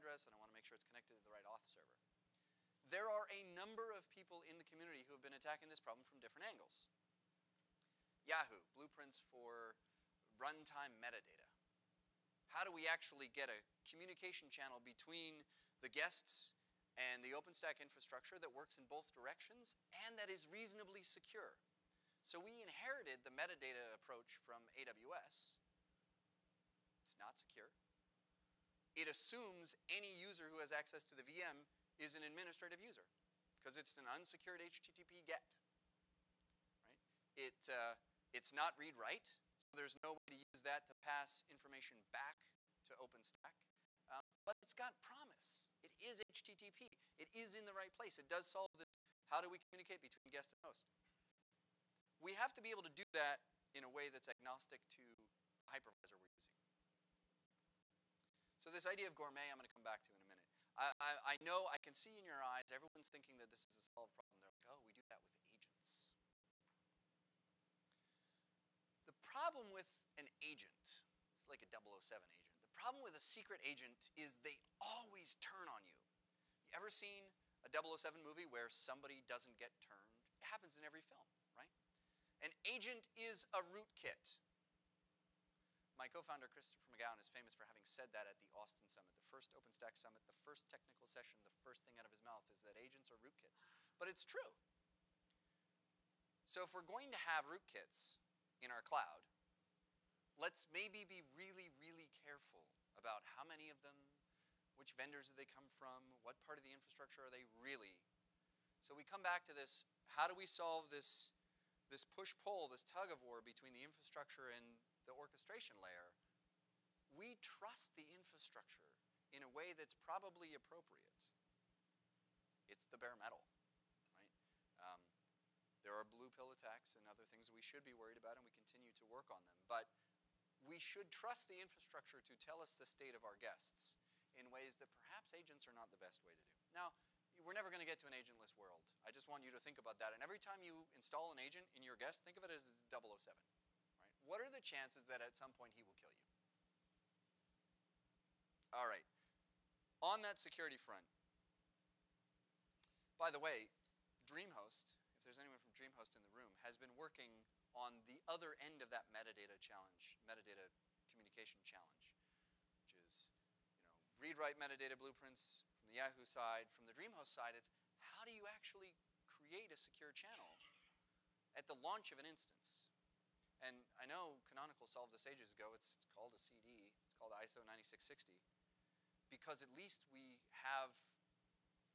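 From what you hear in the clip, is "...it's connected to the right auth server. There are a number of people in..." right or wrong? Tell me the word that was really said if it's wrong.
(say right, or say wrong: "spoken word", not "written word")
right.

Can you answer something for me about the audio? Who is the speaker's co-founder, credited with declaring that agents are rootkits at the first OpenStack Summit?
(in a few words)
Christopher MacGown.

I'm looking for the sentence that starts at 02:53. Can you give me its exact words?
And I know Canonical solved this ages ago.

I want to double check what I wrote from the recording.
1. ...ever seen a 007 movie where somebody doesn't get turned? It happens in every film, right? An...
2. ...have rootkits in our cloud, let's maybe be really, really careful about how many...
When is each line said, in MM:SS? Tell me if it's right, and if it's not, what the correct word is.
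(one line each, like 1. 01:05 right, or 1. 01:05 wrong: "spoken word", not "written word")
1. 01:16 right
2. 01:37 right.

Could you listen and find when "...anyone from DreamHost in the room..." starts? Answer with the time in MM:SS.
02:35.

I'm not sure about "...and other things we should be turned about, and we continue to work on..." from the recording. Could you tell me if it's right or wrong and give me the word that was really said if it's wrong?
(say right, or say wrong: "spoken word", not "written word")
wrong: "worried", not "turned".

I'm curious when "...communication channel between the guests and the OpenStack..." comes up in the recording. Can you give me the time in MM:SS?
00:13.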